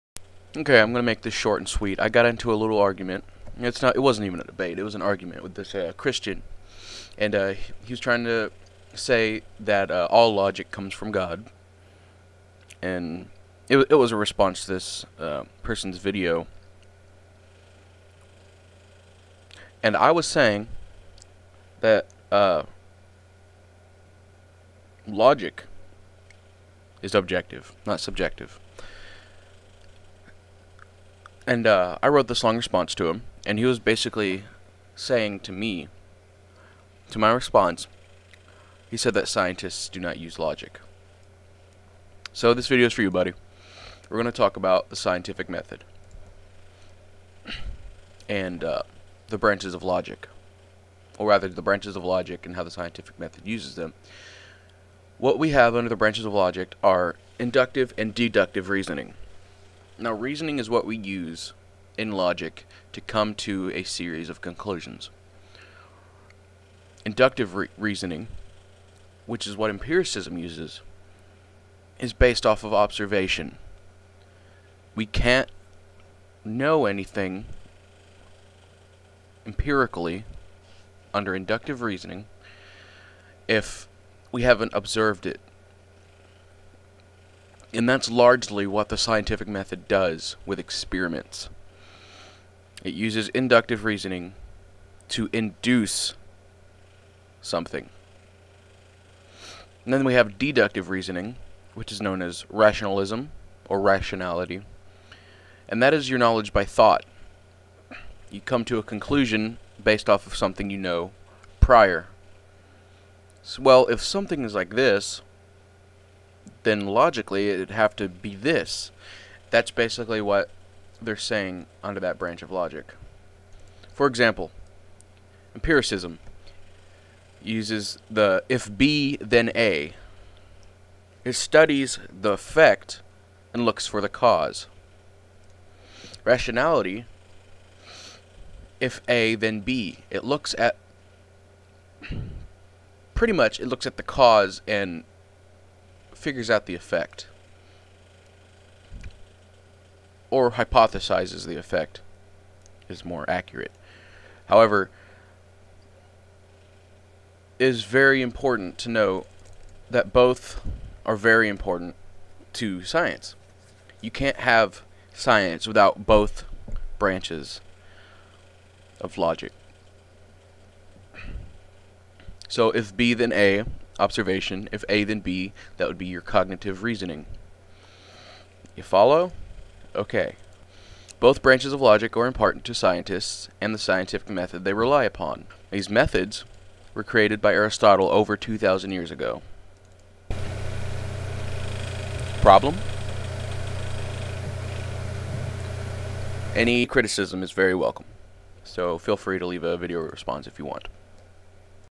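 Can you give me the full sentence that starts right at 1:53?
So, well, if something is like this, then logically it'd have to be this.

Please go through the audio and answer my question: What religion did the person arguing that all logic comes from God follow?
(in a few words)
Christian.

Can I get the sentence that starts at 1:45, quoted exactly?
And that is your knowledge by thought.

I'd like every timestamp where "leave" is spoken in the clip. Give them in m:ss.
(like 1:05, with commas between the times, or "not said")
3:19.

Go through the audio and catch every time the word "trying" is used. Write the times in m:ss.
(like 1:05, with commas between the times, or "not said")
0:08.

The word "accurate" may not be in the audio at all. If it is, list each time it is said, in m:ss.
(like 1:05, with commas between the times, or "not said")
2:33.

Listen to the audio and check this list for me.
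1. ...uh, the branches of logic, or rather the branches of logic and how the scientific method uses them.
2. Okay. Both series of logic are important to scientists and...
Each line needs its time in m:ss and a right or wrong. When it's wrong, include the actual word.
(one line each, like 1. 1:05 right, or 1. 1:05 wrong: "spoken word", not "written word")
1. 0:48 right
2. 2:59 wrong: "branches", not "series".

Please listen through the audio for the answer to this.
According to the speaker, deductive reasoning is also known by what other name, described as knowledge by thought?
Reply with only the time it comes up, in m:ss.
1:42.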